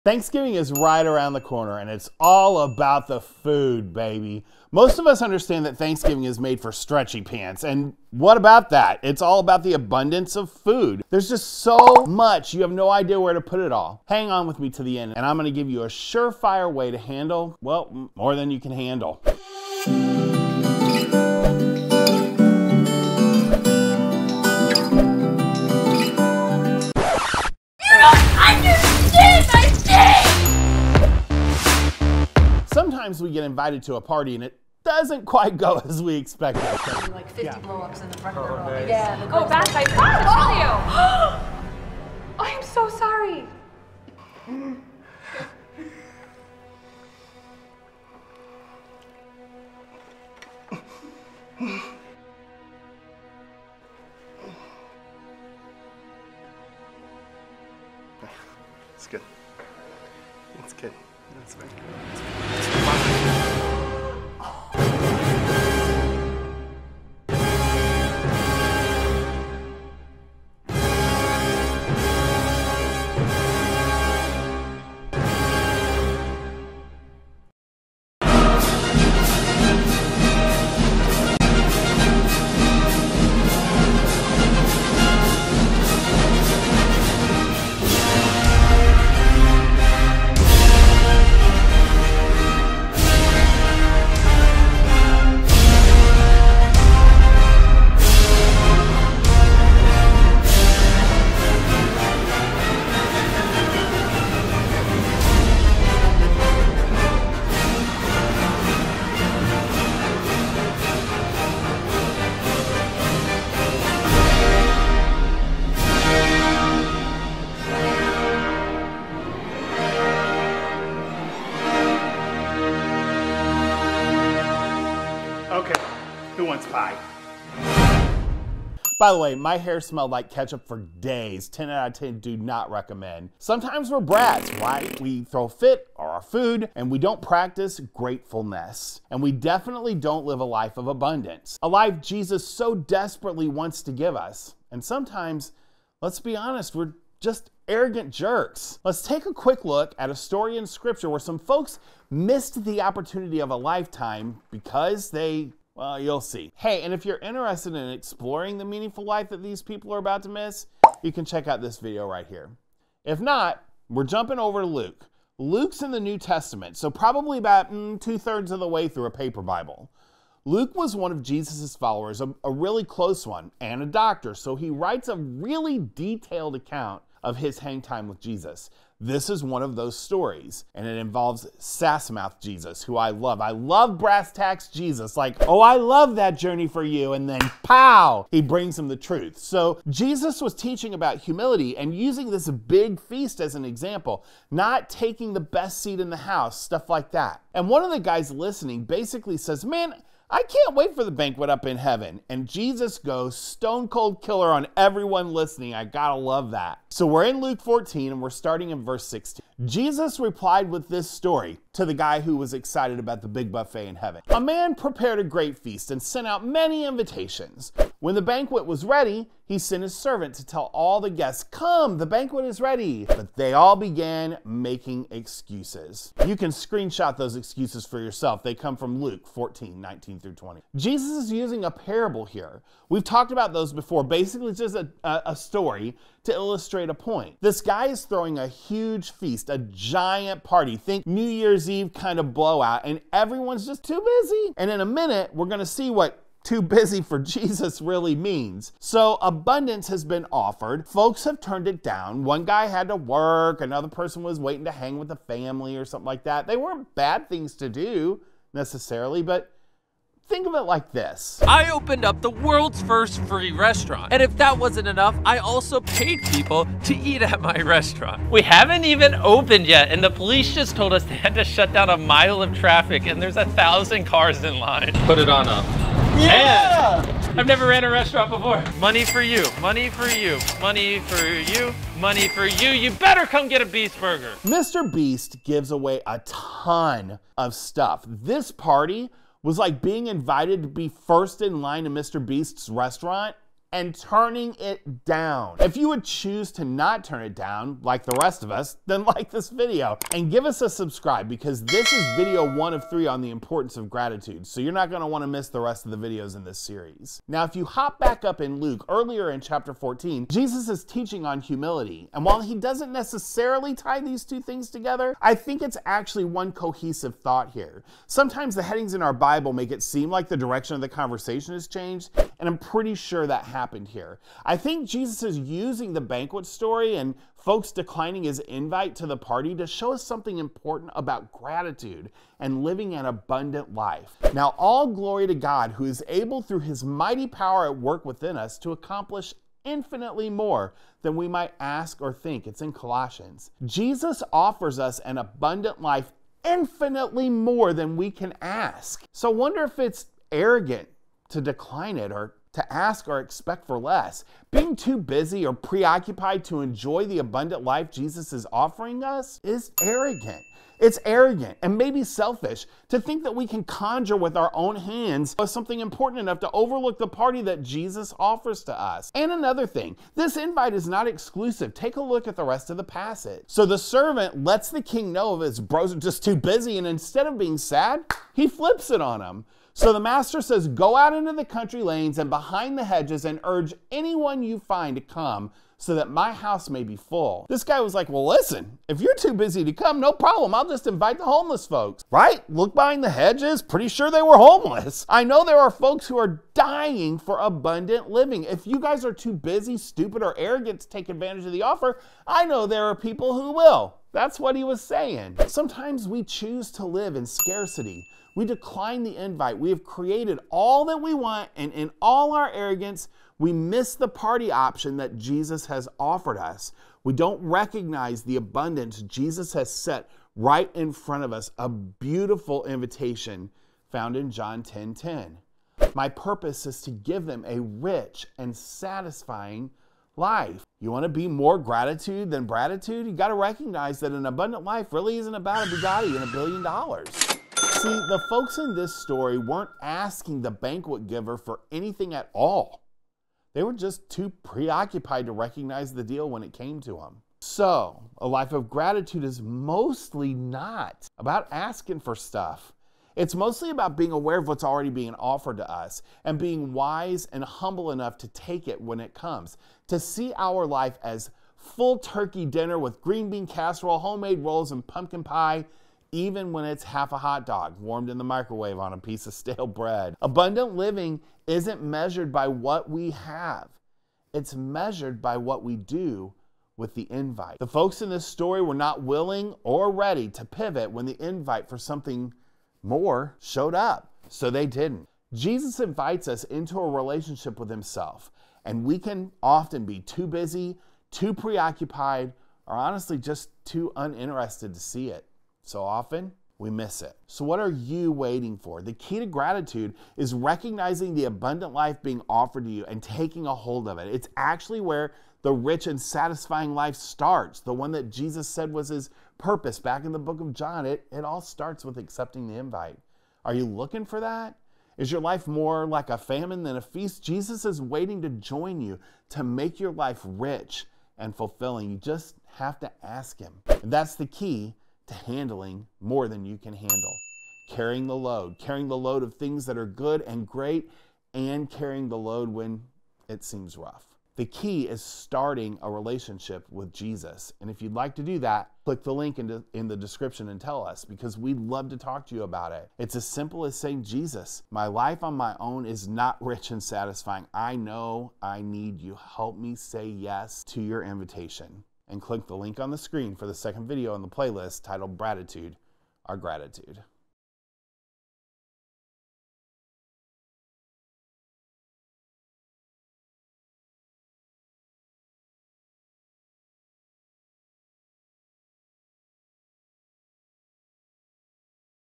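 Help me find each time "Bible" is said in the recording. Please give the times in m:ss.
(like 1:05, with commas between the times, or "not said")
2:49, 5:19.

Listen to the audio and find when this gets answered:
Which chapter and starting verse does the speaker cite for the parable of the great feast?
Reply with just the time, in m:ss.
3:27.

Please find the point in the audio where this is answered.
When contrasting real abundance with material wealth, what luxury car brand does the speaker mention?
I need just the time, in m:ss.
7:15.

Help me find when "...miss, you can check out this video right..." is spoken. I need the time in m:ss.
2:40.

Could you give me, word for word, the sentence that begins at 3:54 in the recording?
Basically, just a, a, a story to illustrate a point.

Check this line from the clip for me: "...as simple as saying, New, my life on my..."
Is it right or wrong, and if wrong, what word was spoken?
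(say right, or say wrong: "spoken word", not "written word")
wrong: "Jesus", not "New".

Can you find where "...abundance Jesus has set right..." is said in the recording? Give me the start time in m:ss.
6:58.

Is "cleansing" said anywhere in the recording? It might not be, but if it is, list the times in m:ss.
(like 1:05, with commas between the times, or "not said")
not said.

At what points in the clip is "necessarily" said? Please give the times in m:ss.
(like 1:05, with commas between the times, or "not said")
4:18, 5:12.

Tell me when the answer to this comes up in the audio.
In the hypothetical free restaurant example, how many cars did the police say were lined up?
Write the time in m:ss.
4:33.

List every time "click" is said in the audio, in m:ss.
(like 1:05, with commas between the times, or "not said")
8:58, 9:12.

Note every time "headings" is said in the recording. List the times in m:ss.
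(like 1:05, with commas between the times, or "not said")
5:18.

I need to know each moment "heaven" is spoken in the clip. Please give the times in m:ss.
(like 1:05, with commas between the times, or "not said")
3:21, 3:33.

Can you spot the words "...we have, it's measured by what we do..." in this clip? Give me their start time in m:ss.
7:52.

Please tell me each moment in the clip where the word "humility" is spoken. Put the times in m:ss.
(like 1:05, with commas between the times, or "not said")
3:11, 5:11.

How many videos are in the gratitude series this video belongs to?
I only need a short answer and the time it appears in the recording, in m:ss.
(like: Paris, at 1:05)
3, at 5:02.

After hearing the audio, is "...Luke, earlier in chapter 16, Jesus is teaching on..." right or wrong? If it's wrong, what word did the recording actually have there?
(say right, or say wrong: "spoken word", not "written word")
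wrong: "14", not "16".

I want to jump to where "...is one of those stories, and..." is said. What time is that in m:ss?
2:59.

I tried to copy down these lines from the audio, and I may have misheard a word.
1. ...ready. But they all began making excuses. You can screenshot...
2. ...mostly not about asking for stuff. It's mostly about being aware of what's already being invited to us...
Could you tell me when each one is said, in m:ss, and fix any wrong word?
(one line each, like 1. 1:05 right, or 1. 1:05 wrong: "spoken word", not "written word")
1. 3:42 right
2. 7:29 wrong: "offered", not "invited".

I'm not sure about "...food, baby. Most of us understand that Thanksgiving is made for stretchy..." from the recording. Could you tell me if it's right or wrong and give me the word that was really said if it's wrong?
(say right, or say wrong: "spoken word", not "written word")
right.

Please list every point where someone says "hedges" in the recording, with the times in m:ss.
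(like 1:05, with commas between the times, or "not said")
6:22, 6:33.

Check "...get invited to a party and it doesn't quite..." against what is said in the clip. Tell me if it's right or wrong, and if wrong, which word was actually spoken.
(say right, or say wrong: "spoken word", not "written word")
right.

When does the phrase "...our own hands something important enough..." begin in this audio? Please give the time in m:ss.
6:04.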